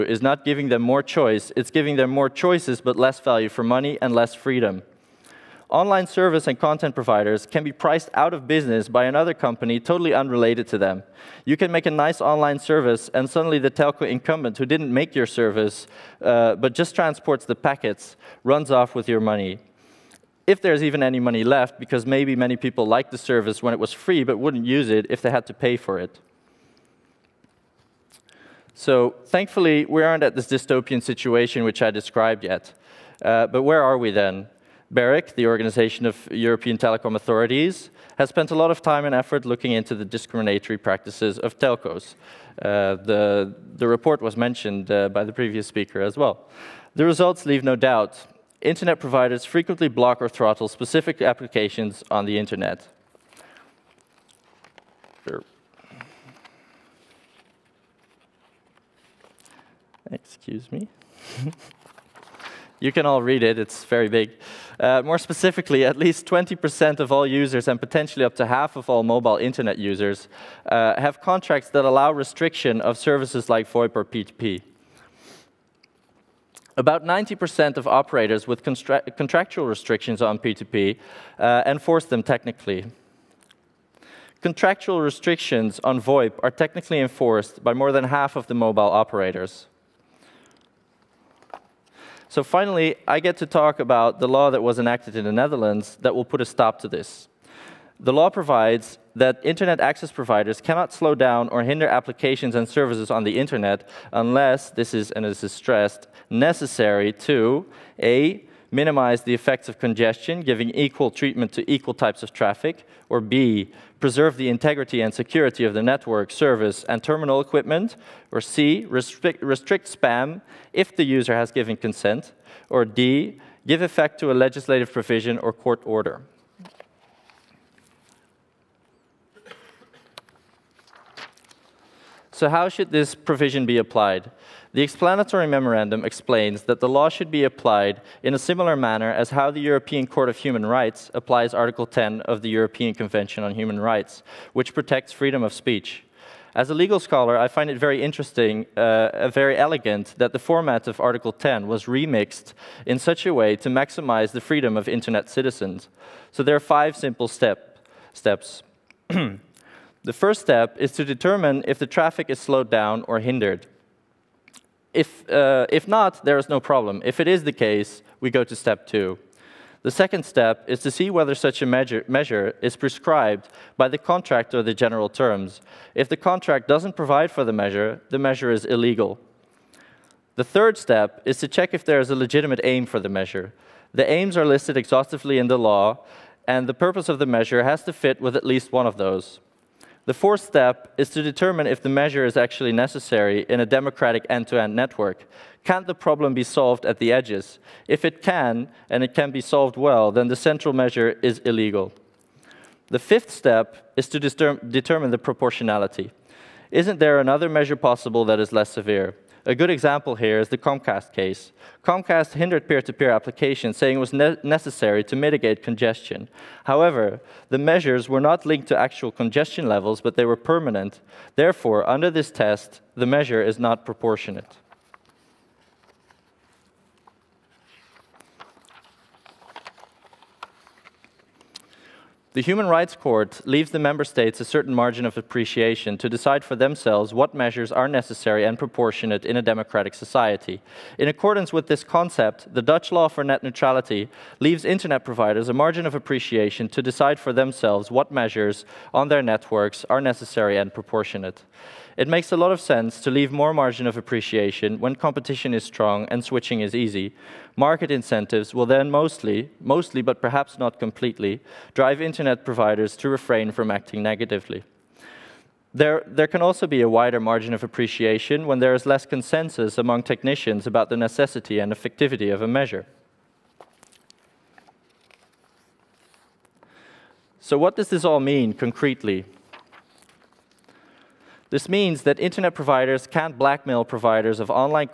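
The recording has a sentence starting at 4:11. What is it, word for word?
It makes a lot of sense to leave more margin of appreciation when competition is strong and switching is easy.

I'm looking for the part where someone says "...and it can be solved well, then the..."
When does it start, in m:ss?
3:18.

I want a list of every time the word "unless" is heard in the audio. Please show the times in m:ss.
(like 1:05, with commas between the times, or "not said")
1:44.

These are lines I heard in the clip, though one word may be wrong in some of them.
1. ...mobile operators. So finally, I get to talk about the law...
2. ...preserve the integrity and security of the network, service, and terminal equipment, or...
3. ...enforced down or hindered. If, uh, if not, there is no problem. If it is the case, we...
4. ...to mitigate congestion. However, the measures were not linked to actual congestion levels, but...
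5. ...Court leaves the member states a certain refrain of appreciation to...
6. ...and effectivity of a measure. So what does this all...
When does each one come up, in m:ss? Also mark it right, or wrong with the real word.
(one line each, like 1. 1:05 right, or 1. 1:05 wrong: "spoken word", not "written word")
1. 1:28 right
2. 1:54 right
3. 2:42 wrong: "slowed", not "enforced"
4. 3:35 right
5. 3:52 wrong: "margin", not "refrain"
6. 4:31 right.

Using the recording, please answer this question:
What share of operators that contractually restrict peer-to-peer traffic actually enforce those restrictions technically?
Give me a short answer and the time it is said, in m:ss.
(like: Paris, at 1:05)
About 90%, at 1:16.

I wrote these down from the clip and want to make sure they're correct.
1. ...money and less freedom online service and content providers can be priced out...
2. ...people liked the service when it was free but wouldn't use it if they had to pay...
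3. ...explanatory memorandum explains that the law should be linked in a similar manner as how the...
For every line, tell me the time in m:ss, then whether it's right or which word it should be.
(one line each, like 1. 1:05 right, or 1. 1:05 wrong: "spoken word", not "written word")
1. 0:03 right
2. 0:22 right
3. 2:14 wrong: "applied", not "linked".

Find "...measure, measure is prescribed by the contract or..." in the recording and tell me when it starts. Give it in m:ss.
2:51.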